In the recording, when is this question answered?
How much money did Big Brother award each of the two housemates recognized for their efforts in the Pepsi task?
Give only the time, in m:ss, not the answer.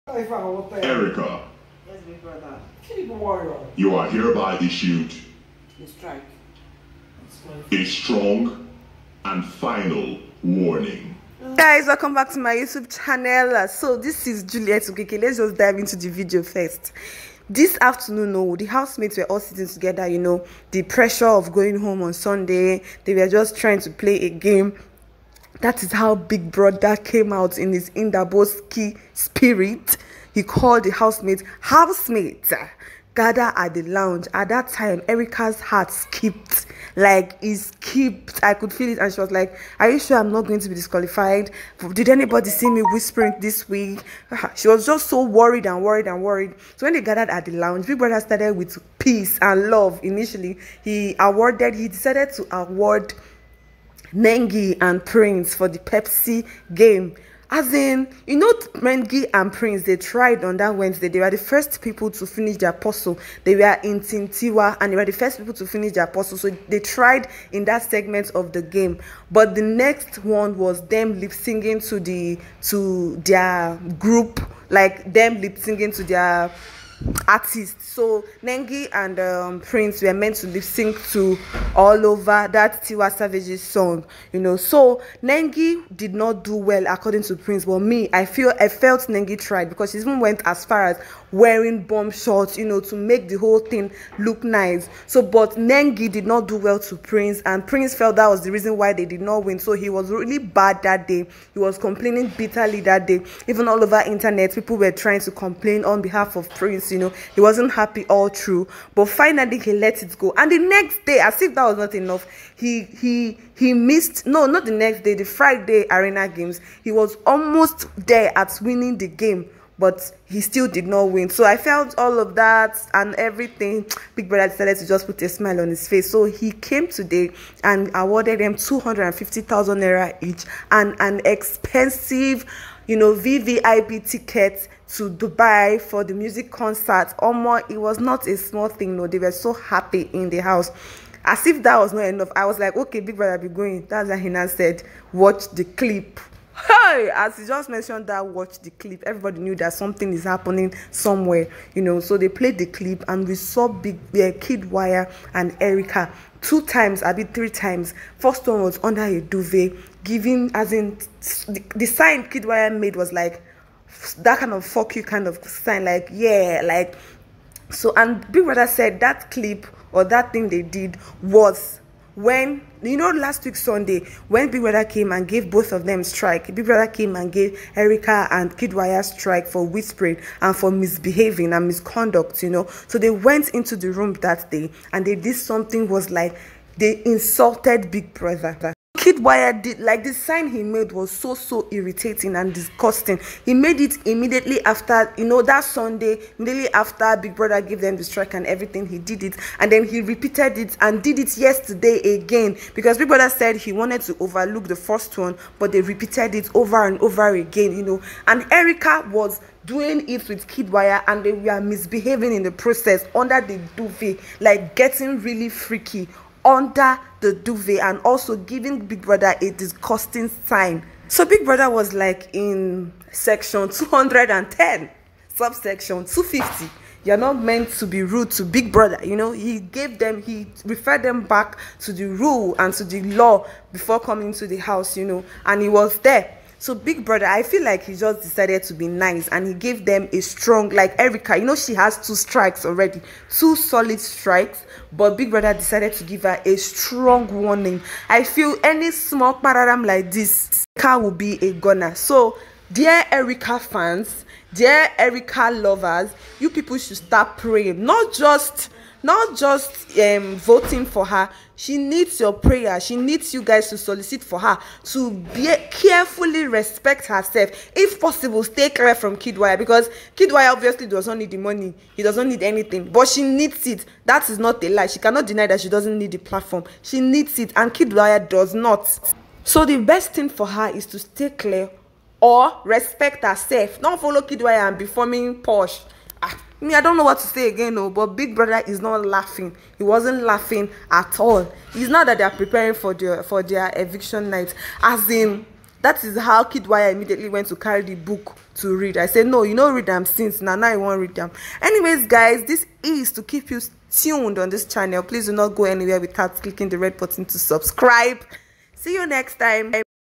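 2:08.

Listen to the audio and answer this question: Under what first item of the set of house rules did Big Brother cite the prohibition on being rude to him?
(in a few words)
Section 210.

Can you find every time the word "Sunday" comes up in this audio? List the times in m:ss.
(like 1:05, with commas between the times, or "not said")
0:22, 2:53, 3:15.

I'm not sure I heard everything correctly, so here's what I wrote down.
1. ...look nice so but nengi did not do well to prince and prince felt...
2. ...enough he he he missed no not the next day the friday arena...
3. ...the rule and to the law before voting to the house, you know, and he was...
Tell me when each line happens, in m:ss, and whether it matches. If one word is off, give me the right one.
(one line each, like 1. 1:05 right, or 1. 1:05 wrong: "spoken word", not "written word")
1. 1:34 right
2. 1:51 right
3. 3:51 wrong: "coming", not "voting".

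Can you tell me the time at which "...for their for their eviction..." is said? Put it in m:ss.
4:52.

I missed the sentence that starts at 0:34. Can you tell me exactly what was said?
At that time, Erica's heart skipped.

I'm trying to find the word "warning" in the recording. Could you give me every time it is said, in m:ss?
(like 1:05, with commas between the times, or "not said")
0:10, 4:07.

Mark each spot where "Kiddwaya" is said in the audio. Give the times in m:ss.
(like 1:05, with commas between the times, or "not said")
2:34, 2:42, 2:58, 3:09, 3:30.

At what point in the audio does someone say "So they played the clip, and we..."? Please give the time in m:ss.
2:32.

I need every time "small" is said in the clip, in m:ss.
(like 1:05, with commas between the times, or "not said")
2:18, 4:08.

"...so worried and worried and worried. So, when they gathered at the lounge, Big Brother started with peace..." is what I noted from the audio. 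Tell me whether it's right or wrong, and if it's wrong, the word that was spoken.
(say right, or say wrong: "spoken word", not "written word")
right.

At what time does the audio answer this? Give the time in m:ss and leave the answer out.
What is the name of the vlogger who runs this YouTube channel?
0:14.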